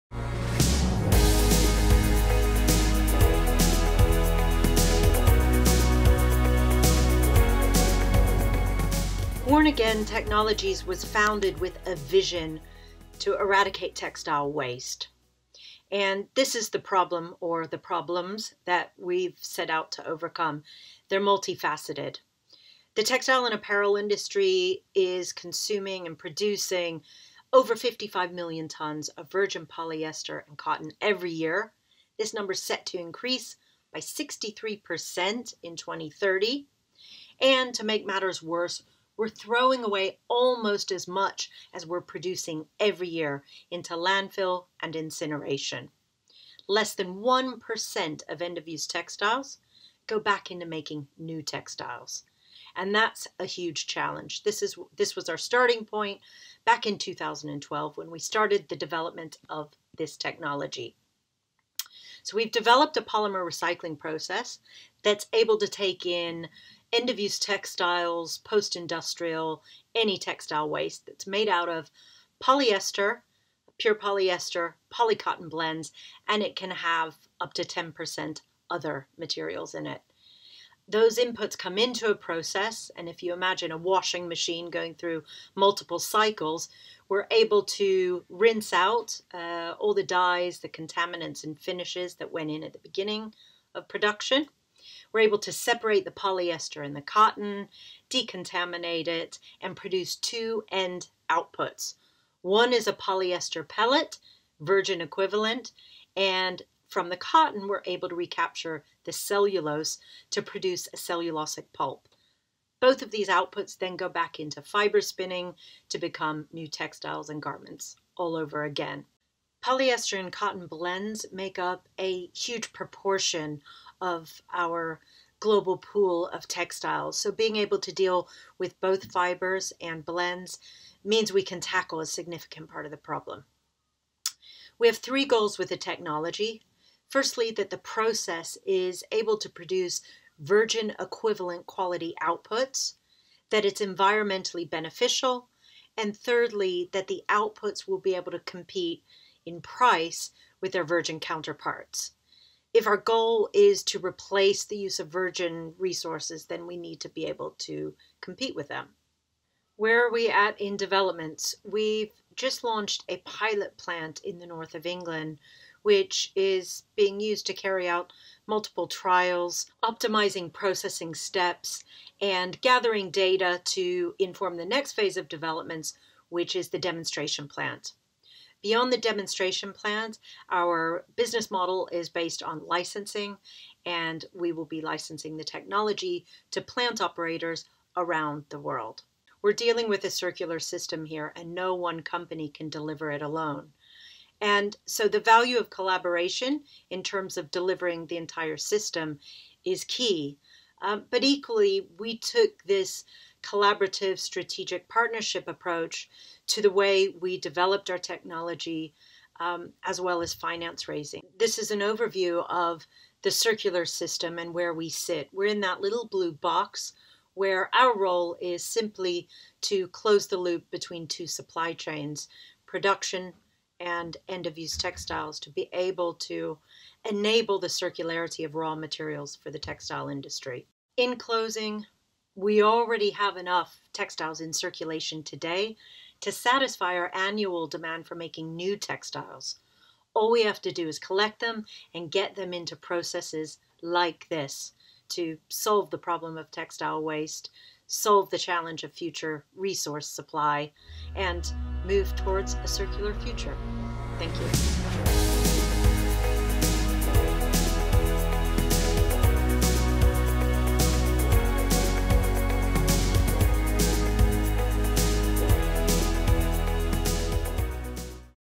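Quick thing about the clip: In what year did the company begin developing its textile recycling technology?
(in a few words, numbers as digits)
2012.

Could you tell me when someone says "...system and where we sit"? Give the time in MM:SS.
03:33.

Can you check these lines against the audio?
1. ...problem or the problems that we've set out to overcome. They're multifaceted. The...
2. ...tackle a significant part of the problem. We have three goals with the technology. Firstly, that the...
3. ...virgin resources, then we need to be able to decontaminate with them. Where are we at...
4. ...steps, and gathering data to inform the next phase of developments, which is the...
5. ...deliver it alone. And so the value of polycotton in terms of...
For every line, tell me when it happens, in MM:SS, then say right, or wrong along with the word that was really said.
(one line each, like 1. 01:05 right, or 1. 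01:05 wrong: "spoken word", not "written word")
1. 00:16 right
2. 02:11 right
3. 02:35 wrong: "compete", not "decontaminate"
4. 02:51 right
5. 03:12 wrong: "collaboration", not "polycotton".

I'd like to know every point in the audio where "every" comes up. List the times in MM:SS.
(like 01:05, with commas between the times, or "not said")
00:31, 00:42.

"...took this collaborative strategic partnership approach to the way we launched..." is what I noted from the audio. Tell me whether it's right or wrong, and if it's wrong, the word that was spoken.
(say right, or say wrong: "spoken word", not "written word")
wrong: "developed", not "launched".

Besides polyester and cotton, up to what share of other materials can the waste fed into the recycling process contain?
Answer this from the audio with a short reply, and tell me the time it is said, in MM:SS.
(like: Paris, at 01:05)
10%, at 01:17.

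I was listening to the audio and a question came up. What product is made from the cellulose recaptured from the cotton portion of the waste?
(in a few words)
cellulosic pulp.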